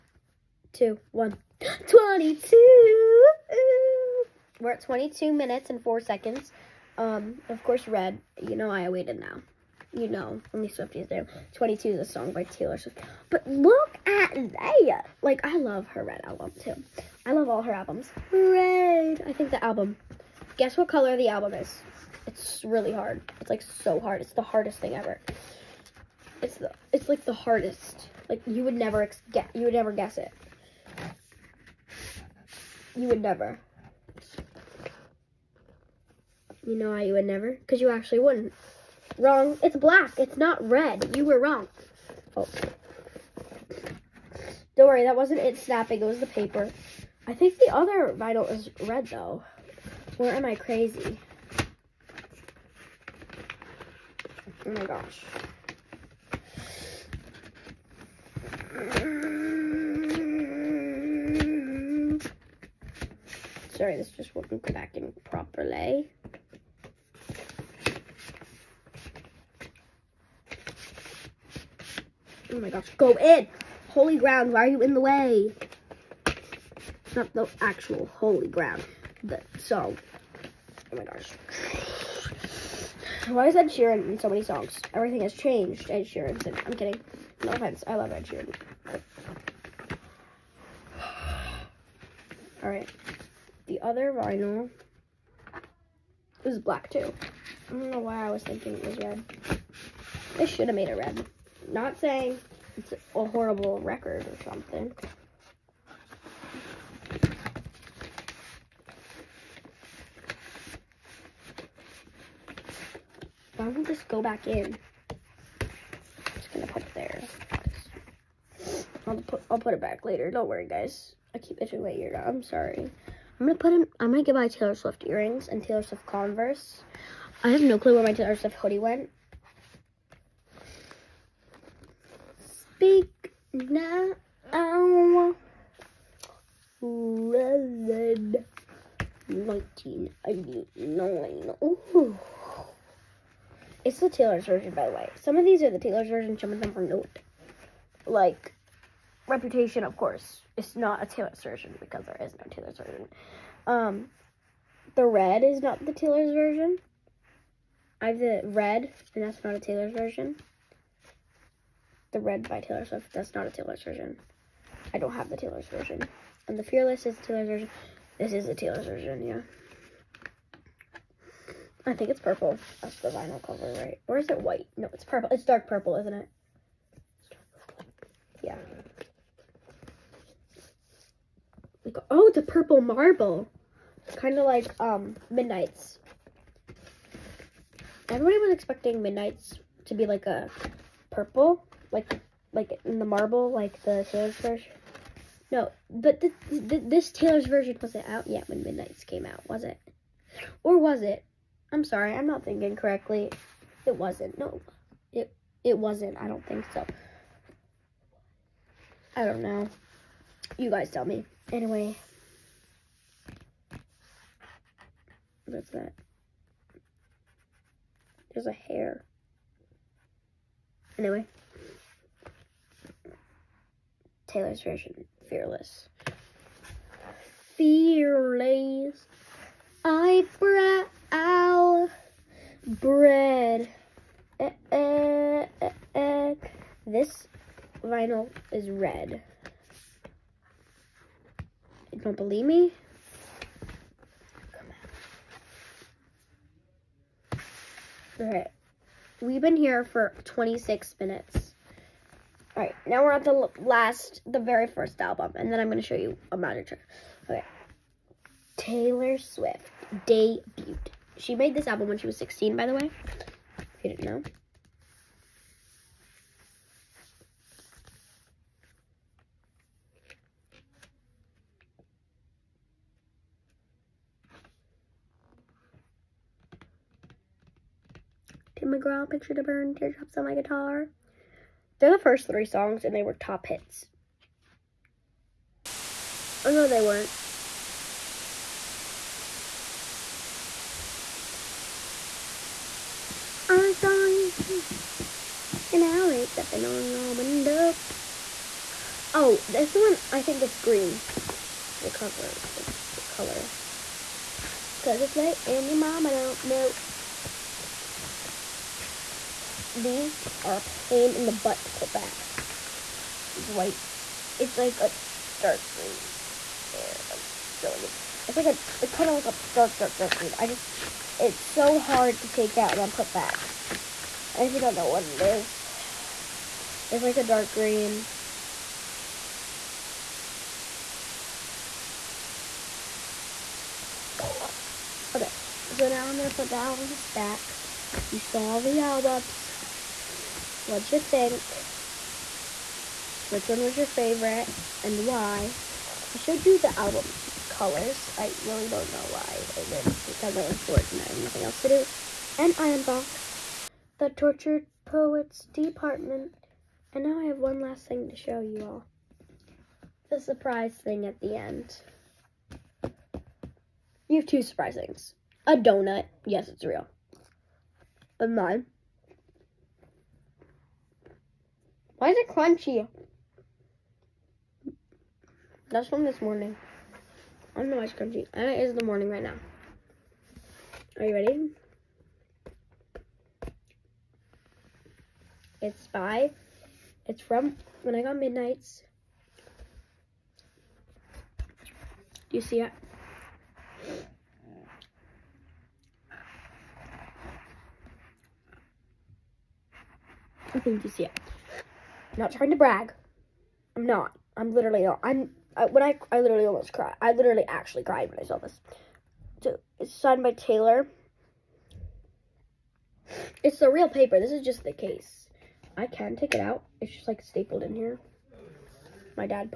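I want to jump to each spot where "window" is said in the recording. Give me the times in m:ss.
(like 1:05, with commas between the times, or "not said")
4:57.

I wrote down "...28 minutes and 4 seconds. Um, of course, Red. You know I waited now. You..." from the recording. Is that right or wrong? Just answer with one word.
wrong.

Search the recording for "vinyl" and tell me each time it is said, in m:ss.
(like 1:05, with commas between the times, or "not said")
0:48, 1:34, 2:53, 3:57.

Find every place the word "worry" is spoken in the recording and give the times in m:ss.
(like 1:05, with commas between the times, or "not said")
0:44, 2:00.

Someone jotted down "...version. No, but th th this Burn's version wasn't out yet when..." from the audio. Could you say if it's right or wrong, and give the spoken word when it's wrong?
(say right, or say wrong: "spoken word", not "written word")
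wrong: "Taylor", not "Burn".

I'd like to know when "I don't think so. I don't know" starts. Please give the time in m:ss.
3:26.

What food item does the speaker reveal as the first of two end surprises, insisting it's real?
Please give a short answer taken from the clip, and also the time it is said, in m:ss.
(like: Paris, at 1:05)
Donut, at 6:05.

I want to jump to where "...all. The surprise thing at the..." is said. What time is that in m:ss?
5:58.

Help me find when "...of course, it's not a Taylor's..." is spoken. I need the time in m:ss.
2:29.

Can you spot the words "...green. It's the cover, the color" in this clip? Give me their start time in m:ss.
5:00.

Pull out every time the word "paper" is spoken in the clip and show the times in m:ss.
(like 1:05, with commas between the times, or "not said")
0:46, 6:53.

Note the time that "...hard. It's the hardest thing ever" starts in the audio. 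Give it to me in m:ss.
0:23.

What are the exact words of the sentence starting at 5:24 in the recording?
And if you don't know what it is, it's like a dark green.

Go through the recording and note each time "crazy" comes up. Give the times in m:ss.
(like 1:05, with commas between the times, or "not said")
0:50.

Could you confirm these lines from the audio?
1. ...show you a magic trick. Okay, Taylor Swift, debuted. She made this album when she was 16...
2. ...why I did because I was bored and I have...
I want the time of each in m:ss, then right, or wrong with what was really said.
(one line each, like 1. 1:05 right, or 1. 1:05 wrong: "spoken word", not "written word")
1. 4:15 right
2. 5:49 right.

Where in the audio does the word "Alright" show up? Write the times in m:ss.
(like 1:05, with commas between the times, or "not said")
1:32, 4:08, 4:12.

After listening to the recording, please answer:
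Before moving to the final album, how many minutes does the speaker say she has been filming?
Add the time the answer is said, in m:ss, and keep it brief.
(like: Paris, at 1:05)
26, at 4:10.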